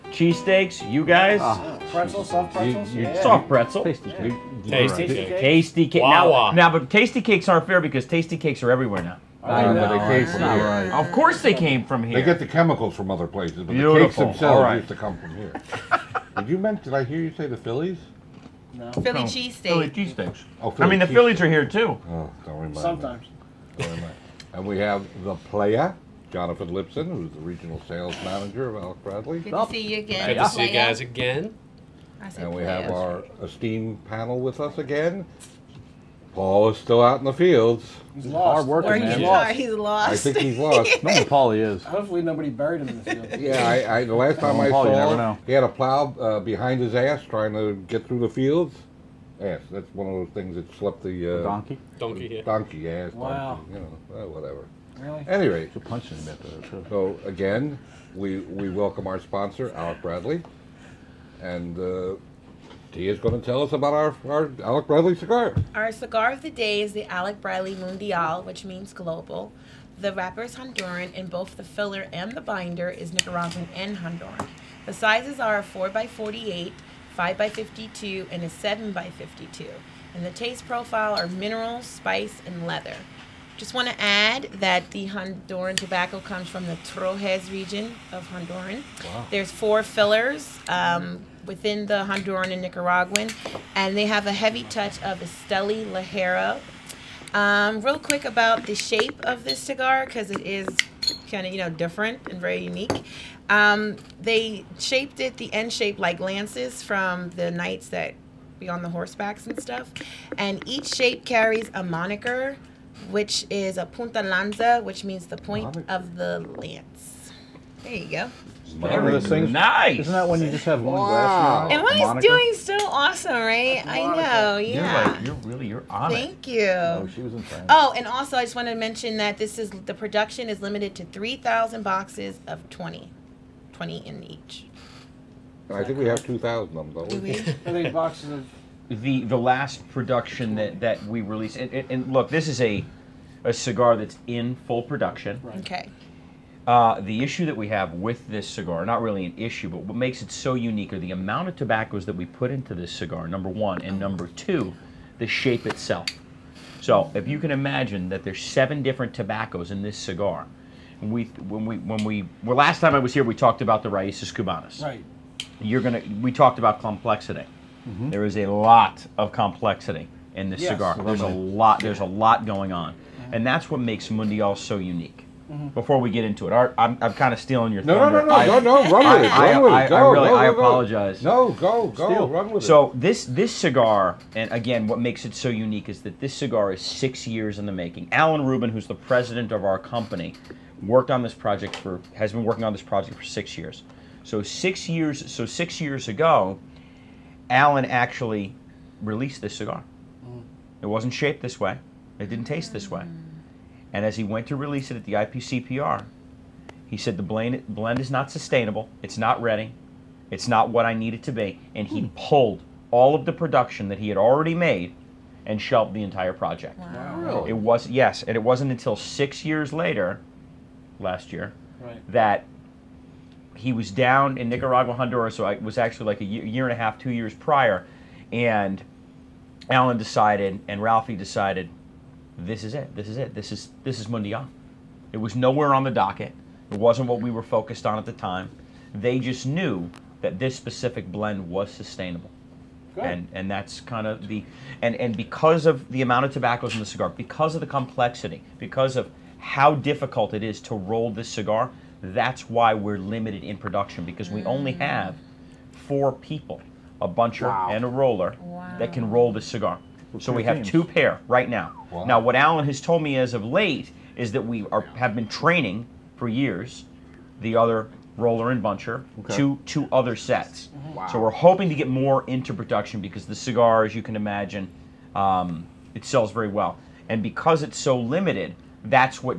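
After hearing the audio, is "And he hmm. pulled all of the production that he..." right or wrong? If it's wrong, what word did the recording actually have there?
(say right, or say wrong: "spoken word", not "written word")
right.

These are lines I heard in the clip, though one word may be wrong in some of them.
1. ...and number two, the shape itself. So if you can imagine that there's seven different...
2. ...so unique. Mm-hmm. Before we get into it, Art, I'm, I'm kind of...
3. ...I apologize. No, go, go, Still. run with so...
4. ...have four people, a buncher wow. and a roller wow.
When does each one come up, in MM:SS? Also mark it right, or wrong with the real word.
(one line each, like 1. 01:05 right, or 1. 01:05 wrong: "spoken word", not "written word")
1. 02:33 right
2. 02:54 right
3. 03:00 right
4. 04:14 right.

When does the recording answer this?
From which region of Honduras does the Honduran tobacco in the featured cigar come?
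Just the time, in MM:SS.
01:26.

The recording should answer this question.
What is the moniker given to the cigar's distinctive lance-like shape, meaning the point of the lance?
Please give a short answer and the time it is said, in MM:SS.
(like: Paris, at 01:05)
Punta lanza, at 01:53.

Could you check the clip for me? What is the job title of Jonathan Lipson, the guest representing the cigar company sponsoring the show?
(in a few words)
Regional sales manager.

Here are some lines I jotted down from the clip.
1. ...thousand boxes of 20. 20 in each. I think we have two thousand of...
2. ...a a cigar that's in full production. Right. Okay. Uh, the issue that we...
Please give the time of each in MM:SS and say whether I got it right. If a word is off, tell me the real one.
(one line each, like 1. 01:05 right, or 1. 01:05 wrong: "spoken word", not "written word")
1. 02:11 right
2. 02:22 right.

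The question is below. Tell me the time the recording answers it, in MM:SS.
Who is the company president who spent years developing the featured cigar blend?
03:08.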